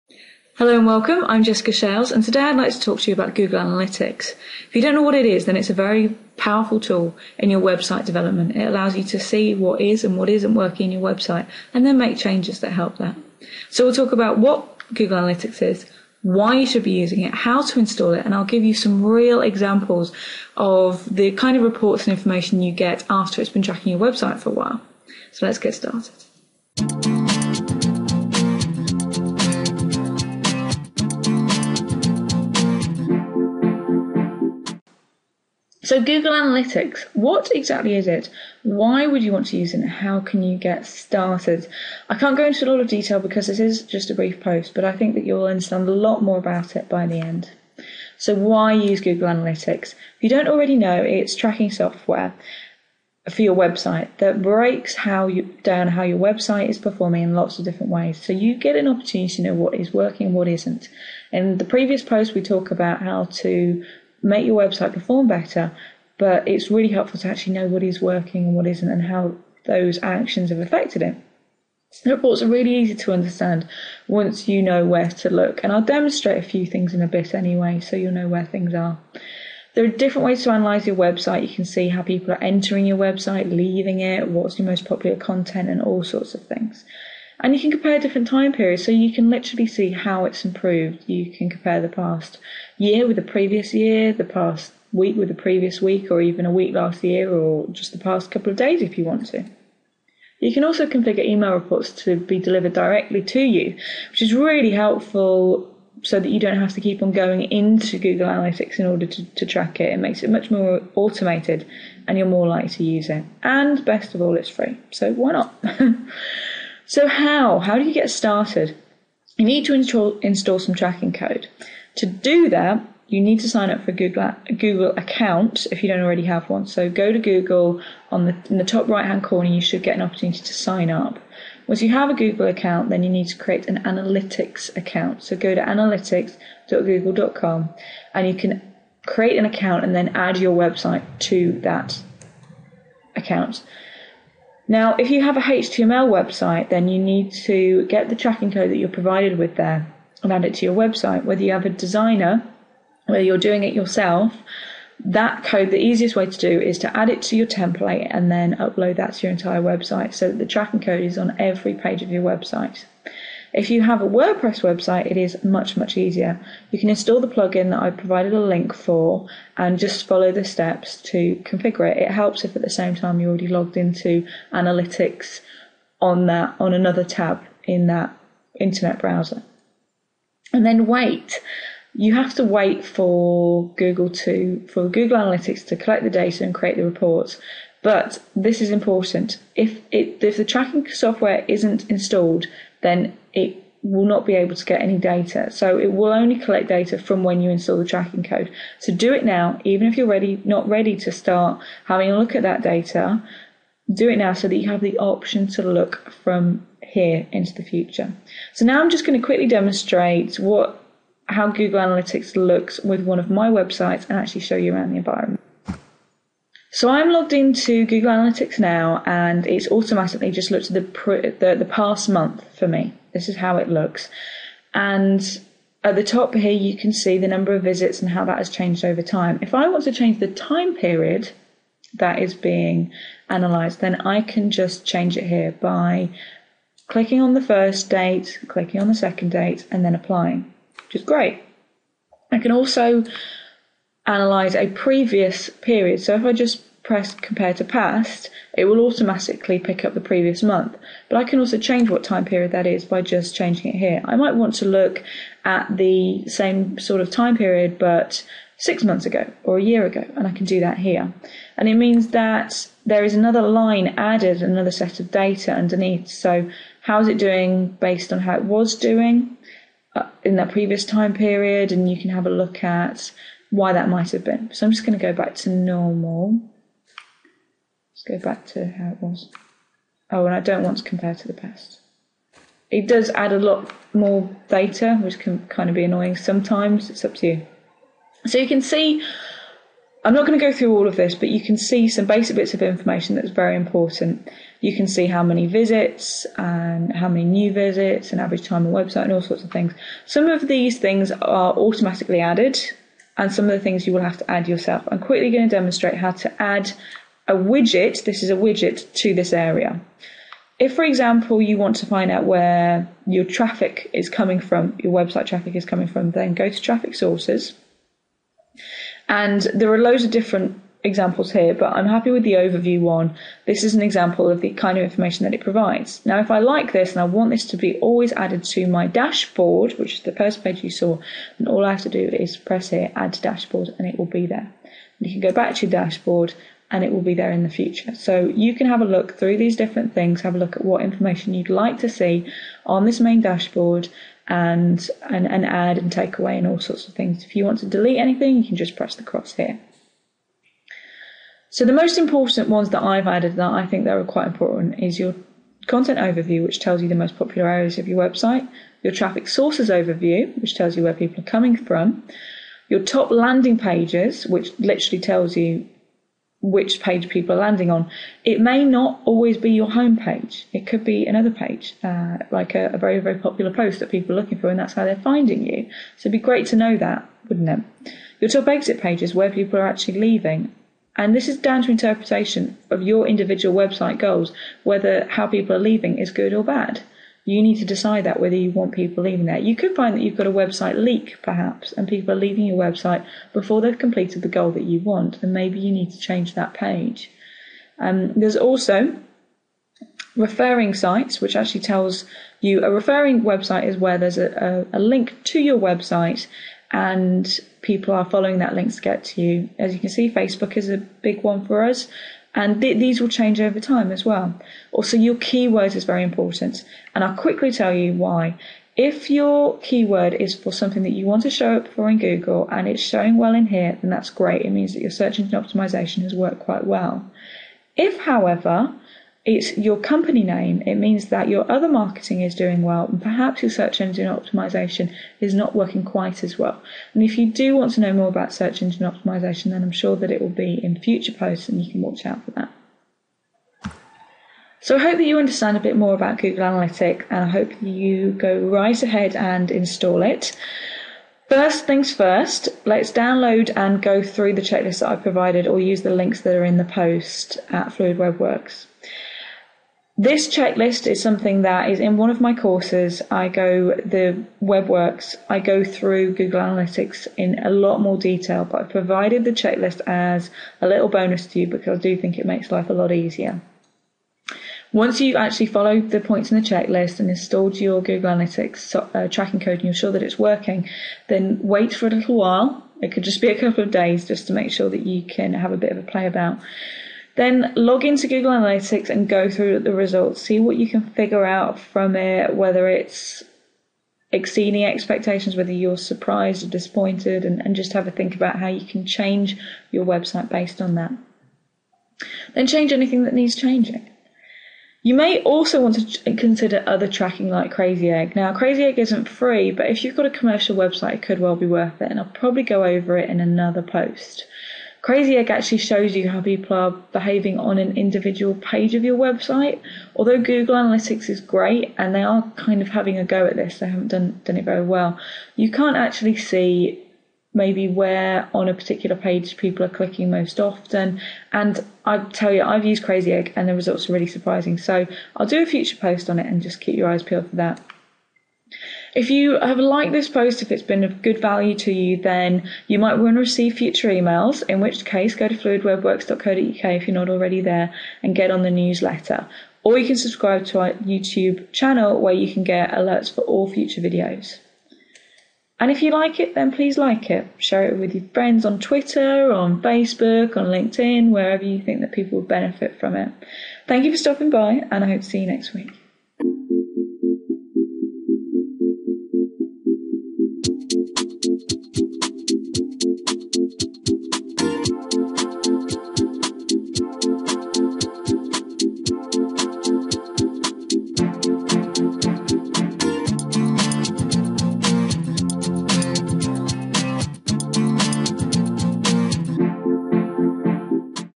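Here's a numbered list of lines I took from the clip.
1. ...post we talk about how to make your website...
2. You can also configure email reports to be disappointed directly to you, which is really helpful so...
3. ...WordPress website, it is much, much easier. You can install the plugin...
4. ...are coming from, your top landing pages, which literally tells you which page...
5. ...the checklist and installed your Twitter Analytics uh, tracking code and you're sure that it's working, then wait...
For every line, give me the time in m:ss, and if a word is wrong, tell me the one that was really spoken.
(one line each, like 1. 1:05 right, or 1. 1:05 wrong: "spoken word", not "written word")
1. 1:02 right
2. 1:40 wrong: "delivered", not "disappointed"
3. 2:44 right
4. 6:01 right
5. 7:56 wrong: "Google", not "Twitter".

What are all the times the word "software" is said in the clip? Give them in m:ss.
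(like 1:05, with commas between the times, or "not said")
0:51, 3:10.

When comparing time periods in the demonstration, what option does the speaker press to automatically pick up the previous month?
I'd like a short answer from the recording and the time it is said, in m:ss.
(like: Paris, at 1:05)
compare to past, at 4:07.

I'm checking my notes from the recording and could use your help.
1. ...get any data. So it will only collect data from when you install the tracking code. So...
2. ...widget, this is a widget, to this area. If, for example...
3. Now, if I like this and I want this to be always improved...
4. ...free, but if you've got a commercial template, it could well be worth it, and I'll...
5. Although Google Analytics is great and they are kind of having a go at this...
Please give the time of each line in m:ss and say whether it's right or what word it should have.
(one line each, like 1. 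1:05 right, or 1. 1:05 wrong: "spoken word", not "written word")
1. 3:14 right
2. 5:07 right
3. 5:26 wrong: "added", not "improved"
4. 8:29 wrong: "website", not "template"
5. 8:39 right.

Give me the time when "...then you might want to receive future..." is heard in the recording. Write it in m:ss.
9:02.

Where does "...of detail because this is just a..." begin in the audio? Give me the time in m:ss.
0:42.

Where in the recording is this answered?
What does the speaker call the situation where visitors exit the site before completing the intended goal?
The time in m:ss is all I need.
6:30.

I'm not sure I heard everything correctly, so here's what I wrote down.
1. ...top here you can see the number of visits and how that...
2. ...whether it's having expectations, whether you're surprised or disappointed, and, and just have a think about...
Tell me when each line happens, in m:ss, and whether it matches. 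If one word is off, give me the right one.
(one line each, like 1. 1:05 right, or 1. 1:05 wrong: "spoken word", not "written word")
1. 3:46 right
2. 8:12 wrong: "exceeding", not "having".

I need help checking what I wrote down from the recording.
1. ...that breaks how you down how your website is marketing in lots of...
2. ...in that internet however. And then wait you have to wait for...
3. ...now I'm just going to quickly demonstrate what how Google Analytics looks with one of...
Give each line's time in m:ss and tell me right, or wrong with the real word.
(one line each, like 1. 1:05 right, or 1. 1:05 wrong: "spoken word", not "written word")
1. 0:54 wrong: "performing", not "marketing"
2. 2:57 wrong: "browser", not "however"
3. 3:28 right.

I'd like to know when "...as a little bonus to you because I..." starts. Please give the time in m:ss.
7:49.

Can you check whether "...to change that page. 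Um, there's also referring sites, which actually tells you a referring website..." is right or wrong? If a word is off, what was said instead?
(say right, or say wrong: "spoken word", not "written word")
right.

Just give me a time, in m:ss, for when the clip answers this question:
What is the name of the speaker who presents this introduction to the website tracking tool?
0:01.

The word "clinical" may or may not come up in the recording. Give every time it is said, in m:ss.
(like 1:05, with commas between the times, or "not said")
not said.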